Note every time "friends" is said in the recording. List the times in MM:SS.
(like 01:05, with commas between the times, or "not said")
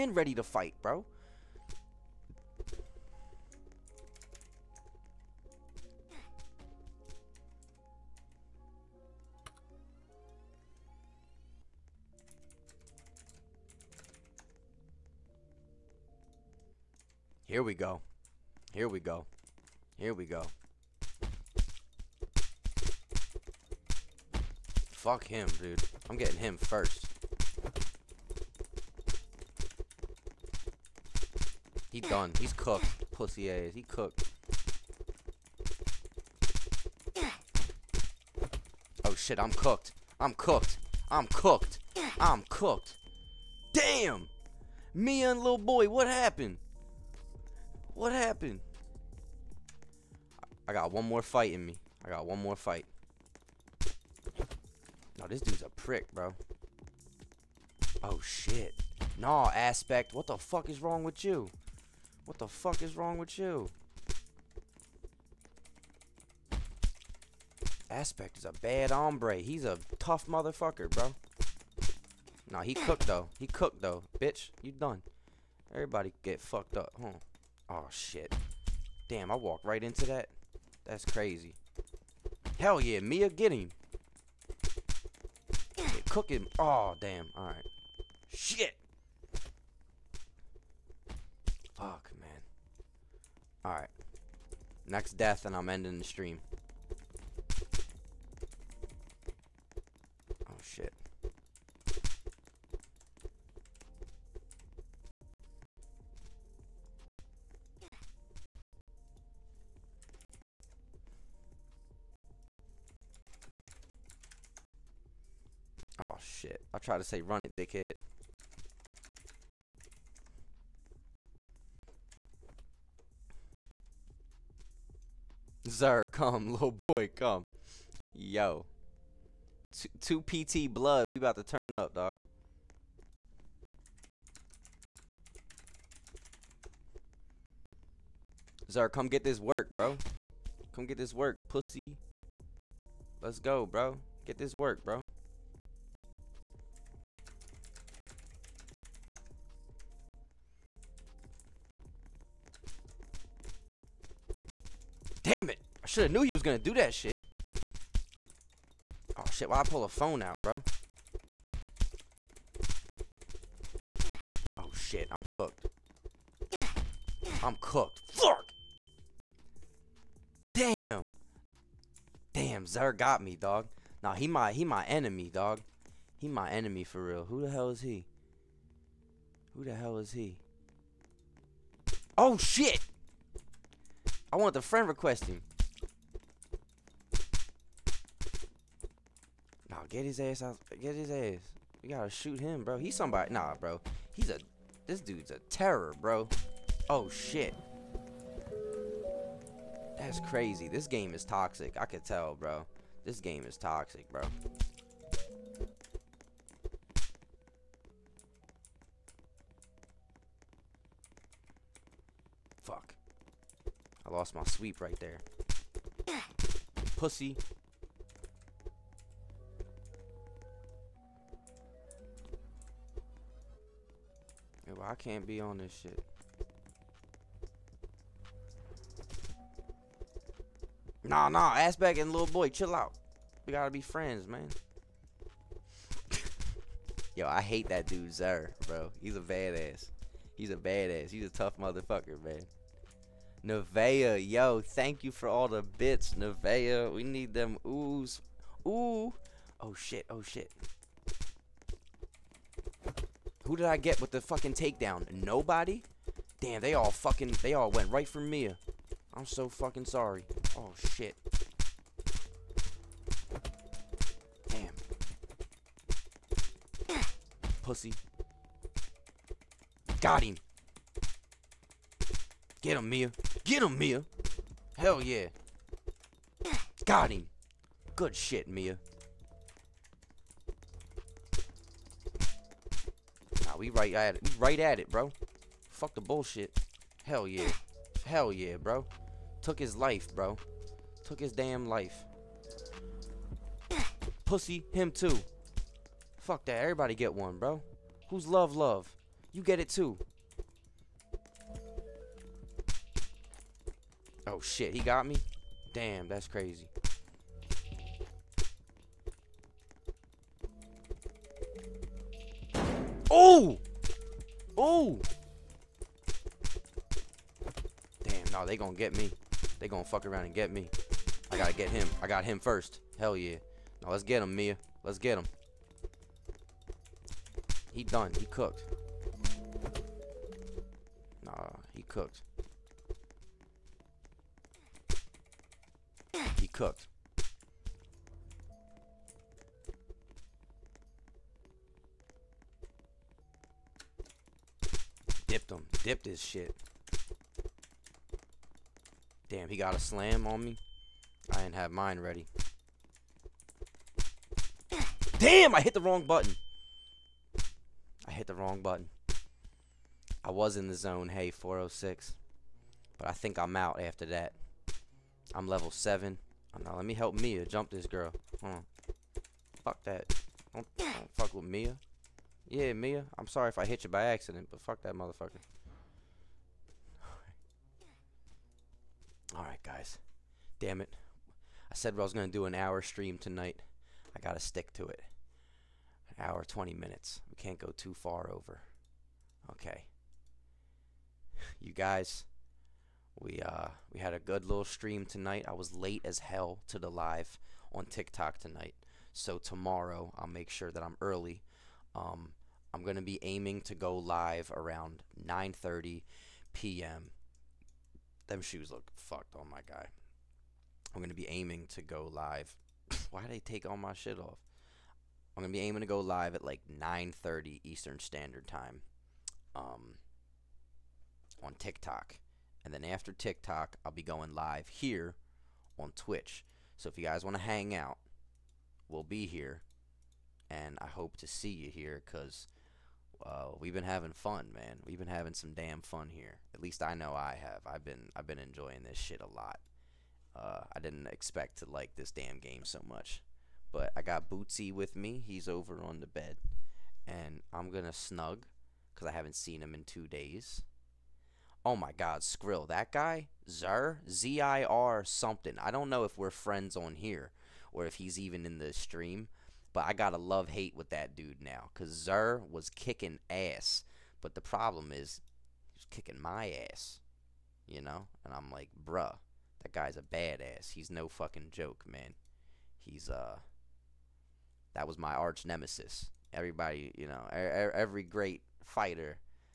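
03:04, 03:53, 07:36.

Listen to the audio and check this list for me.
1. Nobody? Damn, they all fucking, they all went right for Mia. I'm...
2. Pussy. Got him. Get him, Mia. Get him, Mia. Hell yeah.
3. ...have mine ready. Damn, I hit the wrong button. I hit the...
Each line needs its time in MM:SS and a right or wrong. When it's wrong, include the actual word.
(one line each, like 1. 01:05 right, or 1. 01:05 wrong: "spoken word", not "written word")
1. 04:15 right
2. 04:27 right
3. 05:51 right.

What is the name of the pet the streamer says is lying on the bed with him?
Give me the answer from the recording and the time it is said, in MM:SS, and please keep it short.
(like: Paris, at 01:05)
Bootsy, at 07:24.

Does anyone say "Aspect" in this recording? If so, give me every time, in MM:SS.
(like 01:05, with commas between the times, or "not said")
00:59, 01:07, 03:51.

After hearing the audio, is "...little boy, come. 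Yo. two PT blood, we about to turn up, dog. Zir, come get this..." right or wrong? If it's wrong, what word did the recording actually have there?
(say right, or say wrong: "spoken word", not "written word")
right.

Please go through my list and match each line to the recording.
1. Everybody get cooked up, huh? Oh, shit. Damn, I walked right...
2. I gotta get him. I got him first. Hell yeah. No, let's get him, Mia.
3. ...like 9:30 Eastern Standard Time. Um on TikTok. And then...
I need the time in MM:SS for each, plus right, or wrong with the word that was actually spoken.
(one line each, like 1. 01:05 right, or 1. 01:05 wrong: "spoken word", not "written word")
1. 01:15 wrong: "fucked", not "cooked"
2. 05:21 right
3. 06:56 right.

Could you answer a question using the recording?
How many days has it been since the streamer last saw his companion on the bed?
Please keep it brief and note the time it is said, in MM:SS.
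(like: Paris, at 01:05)
2, at 07:29.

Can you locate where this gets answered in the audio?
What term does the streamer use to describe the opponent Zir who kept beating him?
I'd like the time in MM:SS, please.
07:55.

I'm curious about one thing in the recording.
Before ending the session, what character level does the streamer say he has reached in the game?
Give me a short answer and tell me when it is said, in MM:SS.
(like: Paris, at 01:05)
Level 7, at 06:05.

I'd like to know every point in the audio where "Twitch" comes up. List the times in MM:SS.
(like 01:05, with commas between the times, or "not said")
07:05.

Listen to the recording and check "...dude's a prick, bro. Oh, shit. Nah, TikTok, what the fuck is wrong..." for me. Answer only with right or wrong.
wrong.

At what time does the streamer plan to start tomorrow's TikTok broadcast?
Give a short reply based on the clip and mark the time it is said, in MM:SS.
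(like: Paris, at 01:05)
9:30 p.m., at 06:45.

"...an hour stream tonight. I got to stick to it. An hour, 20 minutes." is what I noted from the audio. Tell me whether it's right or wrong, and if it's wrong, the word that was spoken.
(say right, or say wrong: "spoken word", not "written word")
right.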